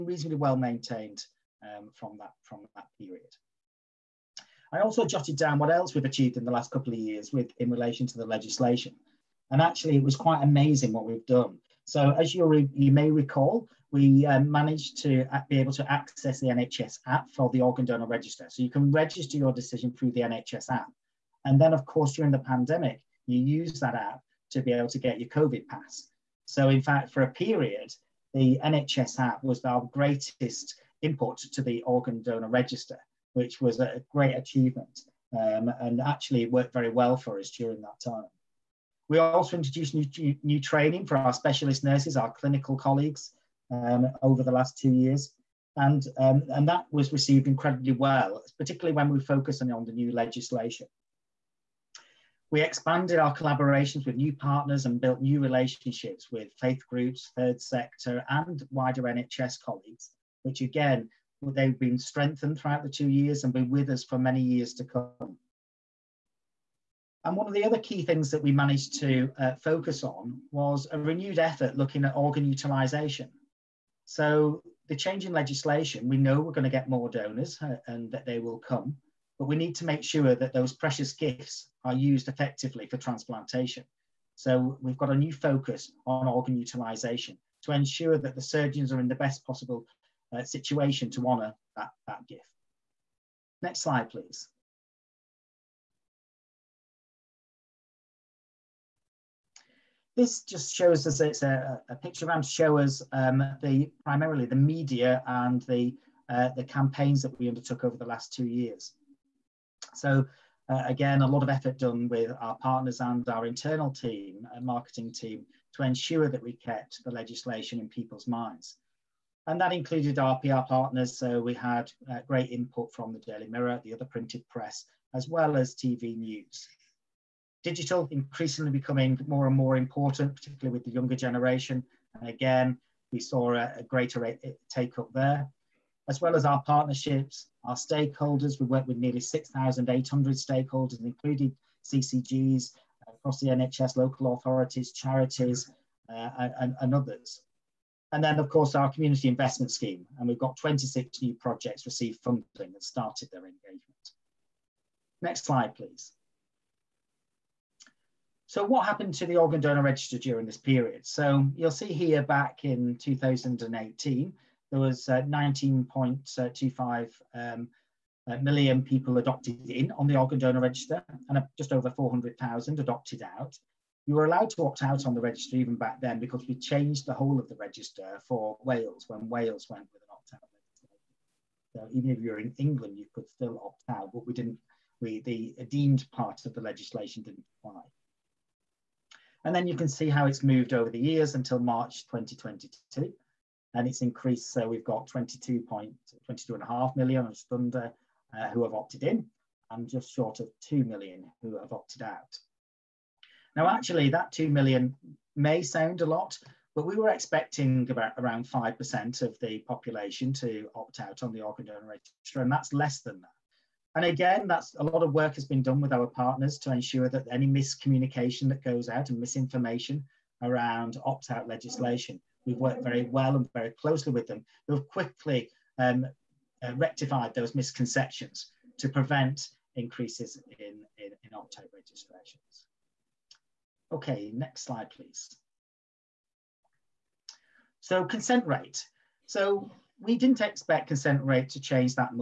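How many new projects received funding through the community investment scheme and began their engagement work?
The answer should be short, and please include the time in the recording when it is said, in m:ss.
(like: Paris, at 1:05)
26, at 2:30.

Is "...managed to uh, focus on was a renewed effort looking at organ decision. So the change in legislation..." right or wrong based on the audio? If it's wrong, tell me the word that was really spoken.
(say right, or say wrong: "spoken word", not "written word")
wrong: "utilisation", not "decision".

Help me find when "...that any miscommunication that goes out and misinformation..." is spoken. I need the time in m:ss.
3:37.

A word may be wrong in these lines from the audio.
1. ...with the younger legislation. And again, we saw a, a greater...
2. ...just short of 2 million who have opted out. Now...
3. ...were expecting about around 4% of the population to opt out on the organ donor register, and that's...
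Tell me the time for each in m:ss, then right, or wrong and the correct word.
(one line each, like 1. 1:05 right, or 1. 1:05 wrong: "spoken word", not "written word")
1. 2:10 wrong: "generation", not "legislation"
2. 3:19 right
3. 3:26 wrong: "5", not "4".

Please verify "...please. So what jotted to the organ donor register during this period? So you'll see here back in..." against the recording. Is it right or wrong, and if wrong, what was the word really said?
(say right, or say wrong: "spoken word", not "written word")
wrong: "happened", not "jotted".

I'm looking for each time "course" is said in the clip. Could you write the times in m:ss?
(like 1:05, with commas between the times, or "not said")
0:21, 2:28.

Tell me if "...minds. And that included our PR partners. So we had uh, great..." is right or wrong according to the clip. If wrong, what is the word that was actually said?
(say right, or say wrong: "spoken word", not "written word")
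right.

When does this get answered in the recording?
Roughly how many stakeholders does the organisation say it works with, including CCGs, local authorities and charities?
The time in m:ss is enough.
2:19.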